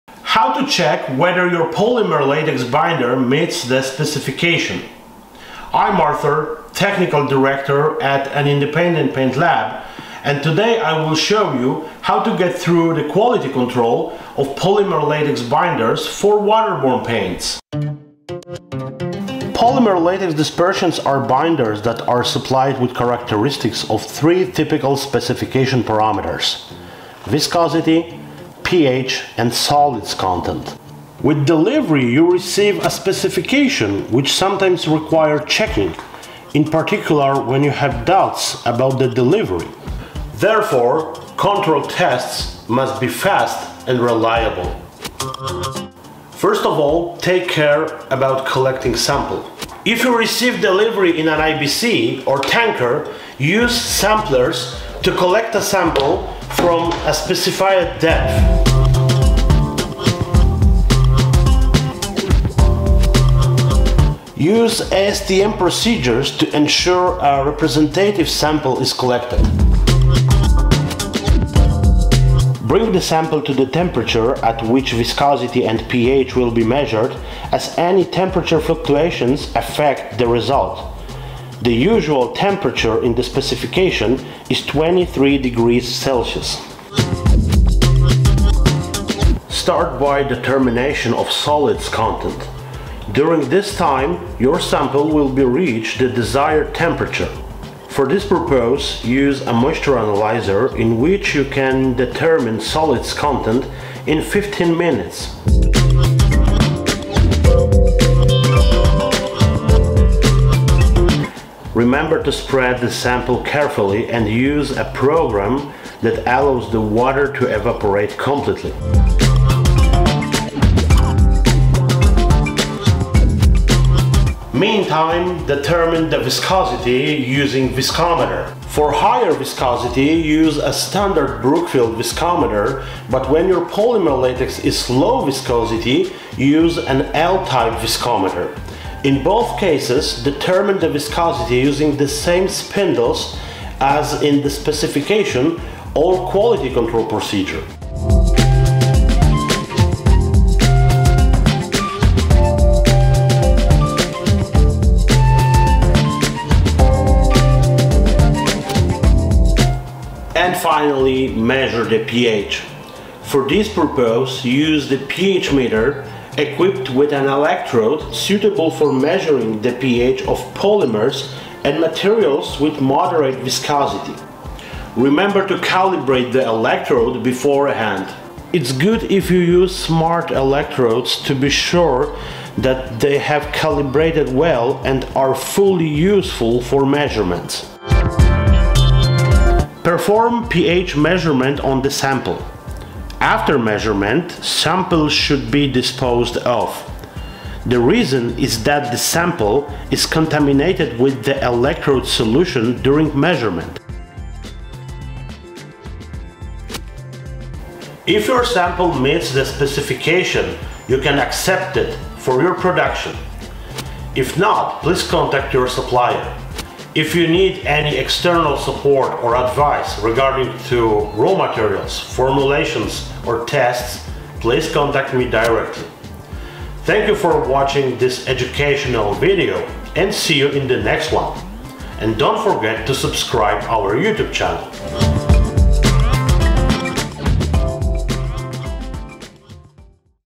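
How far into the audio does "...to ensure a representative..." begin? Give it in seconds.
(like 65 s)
66 s.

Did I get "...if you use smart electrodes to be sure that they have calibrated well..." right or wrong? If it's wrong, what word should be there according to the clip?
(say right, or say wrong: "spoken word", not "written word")
right.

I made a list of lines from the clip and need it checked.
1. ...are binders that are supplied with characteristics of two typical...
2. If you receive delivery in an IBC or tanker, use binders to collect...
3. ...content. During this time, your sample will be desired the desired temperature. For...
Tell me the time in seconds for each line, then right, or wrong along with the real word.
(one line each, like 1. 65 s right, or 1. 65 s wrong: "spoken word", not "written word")
1. 20 s wrong: "three", not "two"
2. 49 s wrong: "samplers", not "binders"
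3. 91 s wrong: "reached", not "desired".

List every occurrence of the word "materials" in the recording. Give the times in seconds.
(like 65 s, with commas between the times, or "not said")
171 s, 221 s.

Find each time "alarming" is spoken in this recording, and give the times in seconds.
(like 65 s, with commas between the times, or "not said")
not said.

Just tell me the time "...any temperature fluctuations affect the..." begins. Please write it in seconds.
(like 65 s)
77 s.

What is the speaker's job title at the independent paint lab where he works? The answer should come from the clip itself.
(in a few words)
Technical Director.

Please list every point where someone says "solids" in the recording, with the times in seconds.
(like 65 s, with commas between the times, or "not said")
29 s, 91 s, 102 s.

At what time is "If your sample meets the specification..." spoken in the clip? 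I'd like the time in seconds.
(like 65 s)
208 s.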